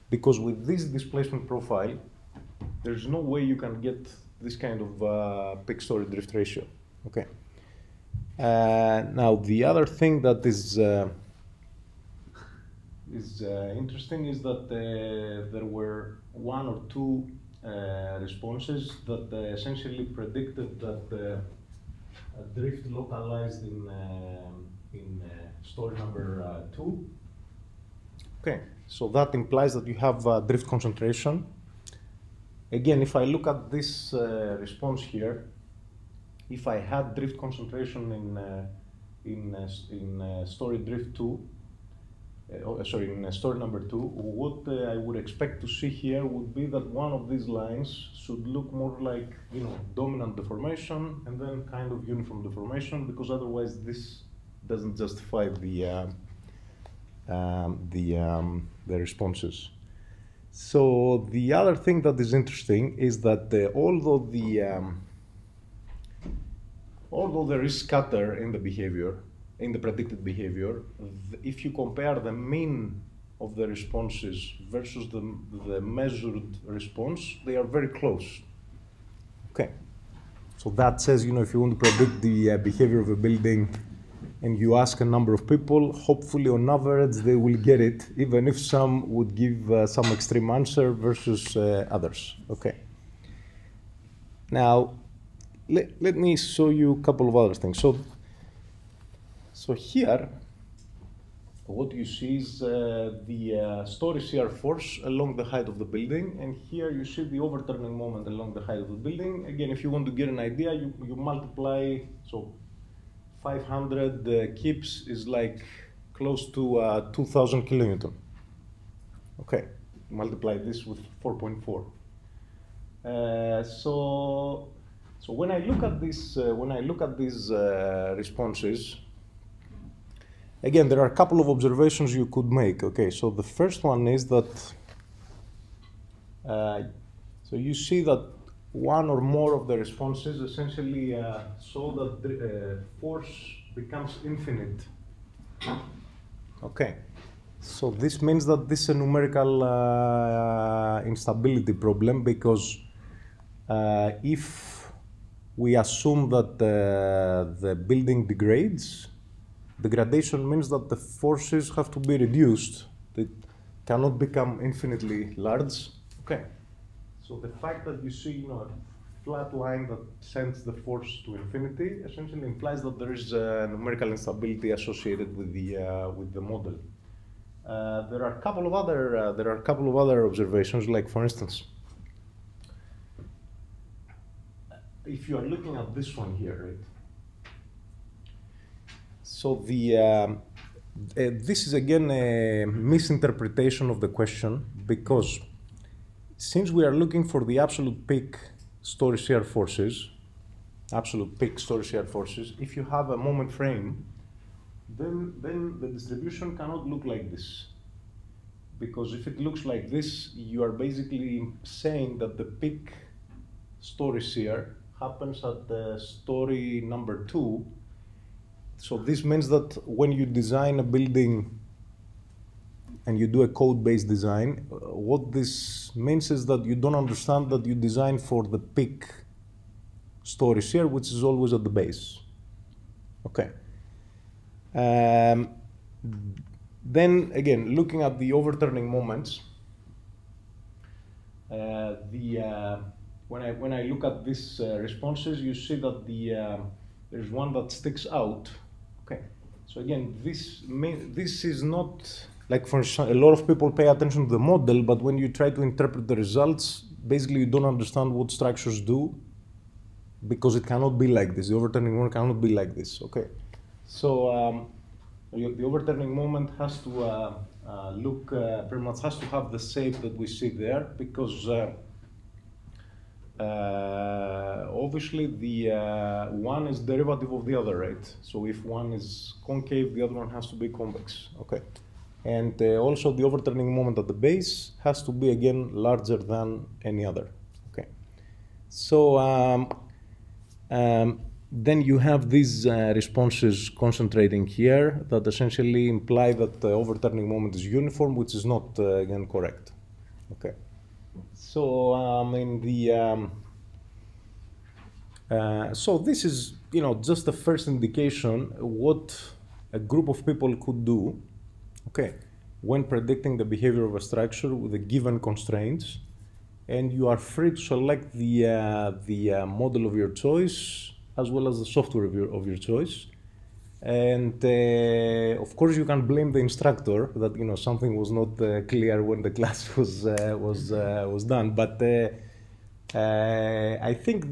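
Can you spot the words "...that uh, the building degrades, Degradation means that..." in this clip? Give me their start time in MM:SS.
02:36.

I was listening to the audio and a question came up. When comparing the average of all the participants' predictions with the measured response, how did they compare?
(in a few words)
Very close.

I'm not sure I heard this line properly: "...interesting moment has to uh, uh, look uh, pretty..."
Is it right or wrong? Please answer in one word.
wrong.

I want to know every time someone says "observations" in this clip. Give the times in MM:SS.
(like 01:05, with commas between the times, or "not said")
02:11, 03:00.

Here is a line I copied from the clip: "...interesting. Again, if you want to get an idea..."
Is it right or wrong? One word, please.
wrong.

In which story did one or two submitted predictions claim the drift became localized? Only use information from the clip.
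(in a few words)
Story 2.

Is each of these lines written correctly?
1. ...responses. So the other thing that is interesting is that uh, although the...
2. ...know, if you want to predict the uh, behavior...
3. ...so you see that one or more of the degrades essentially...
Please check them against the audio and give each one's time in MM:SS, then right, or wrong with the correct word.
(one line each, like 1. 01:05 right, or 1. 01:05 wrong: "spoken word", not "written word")
1. 00:58 right
2. 01:21 right
3. 02:17 wrong: "responses", not "degrades".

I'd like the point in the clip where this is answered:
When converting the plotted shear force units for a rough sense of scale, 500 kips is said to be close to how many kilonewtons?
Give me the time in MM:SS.
01:57.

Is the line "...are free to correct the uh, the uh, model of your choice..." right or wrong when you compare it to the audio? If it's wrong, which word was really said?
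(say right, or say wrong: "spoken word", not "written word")
wrong: "select", not "correct".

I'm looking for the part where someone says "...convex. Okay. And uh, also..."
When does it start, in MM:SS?
04:40.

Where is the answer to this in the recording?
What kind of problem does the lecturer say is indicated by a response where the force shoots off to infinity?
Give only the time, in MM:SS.
02:28.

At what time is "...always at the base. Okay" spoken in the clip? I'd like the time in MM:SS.
03:51.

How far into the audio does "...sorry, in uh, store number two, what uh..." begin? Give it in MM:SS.
00:42.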